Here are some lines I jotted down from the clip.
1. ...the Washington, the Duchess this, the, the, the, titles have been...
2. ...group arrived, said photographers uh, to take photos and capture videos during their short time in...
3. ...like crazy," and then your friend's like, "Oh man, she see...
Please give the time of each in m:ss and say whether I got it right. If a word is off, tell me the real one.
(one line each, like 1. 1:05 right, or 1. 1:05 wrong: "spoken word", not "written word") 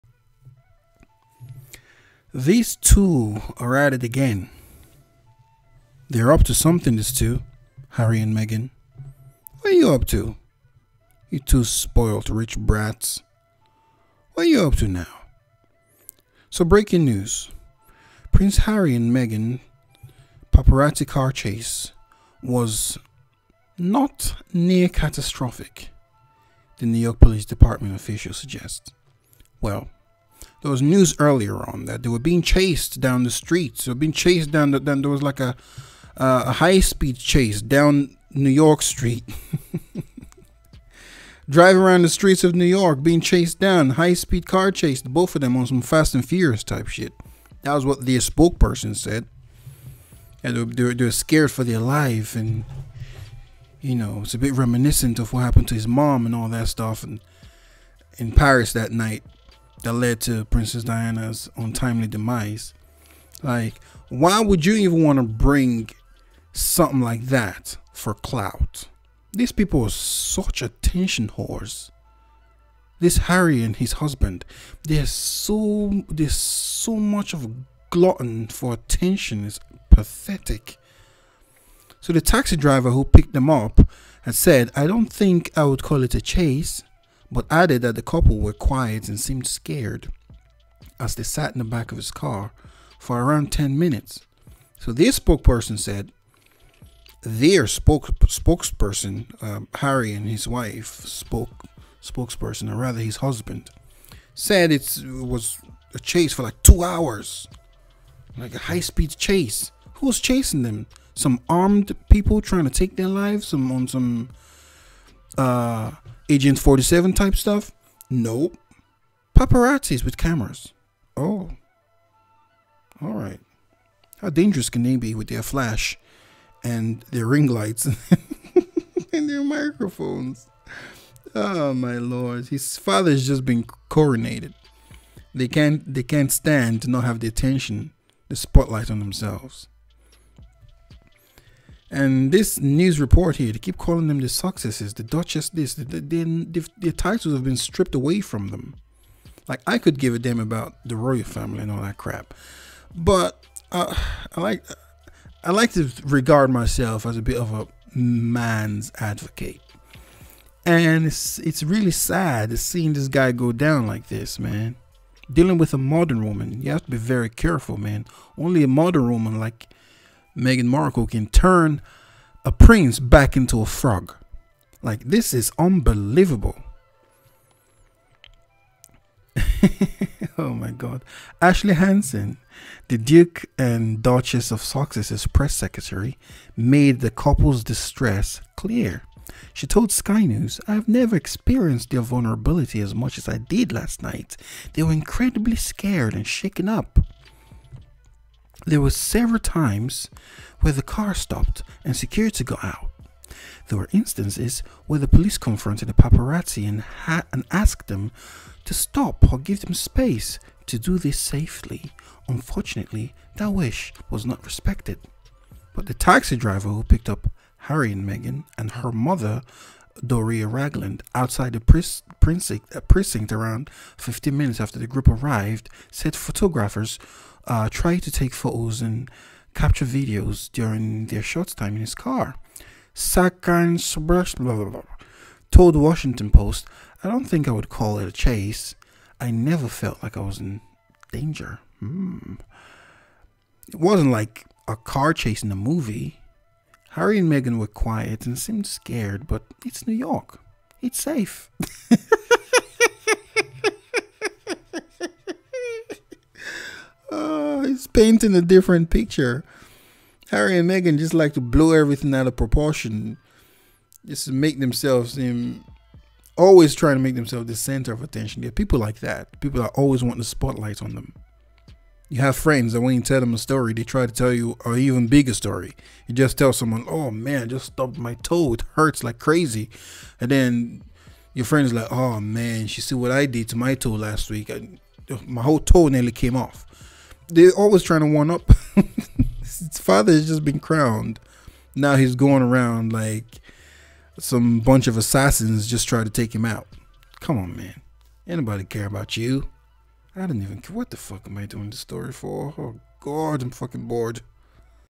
1. 2:24 wrong: "Sussexes", not "Washington"
2. 3:44 right
3. 4:39 right.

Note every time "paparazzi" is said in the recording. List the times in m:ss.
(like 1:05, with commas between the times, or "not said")
0:20, 1:59, 3:25.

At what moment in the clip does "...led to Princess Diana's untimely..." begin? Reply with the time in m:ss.
0:59.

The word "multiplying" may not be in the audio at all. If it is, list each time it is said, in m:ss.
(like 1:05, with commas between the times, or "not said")
not said.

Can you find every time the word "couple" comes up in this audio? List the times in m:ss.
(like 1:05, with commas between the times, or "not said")
1:28, 3:07.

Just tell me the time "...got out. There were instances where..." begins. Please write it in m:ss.
3:22.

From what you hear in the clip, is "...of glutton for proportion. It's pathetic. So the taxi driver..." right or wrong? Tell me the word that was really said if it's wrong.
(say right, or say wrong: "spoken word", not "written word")
wrong: "attention", not "proportion".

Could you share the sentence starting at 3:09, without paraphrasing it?
She told Sky News, I've never experienced their vulnerability as much as I did last night.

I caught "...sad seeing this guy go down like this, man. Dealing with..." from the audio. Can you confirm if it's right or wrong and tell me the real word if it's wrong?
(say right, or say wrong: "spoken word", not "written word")
right.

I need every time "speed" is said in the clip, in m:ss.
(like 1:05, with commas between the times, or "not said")
0:36, 0:44, 1:48.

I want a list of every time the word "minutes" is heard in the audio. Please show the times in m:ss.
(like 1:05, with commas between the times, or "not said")
1:33, 3:44.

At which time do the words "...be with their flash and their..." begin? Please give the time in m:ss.
2:04.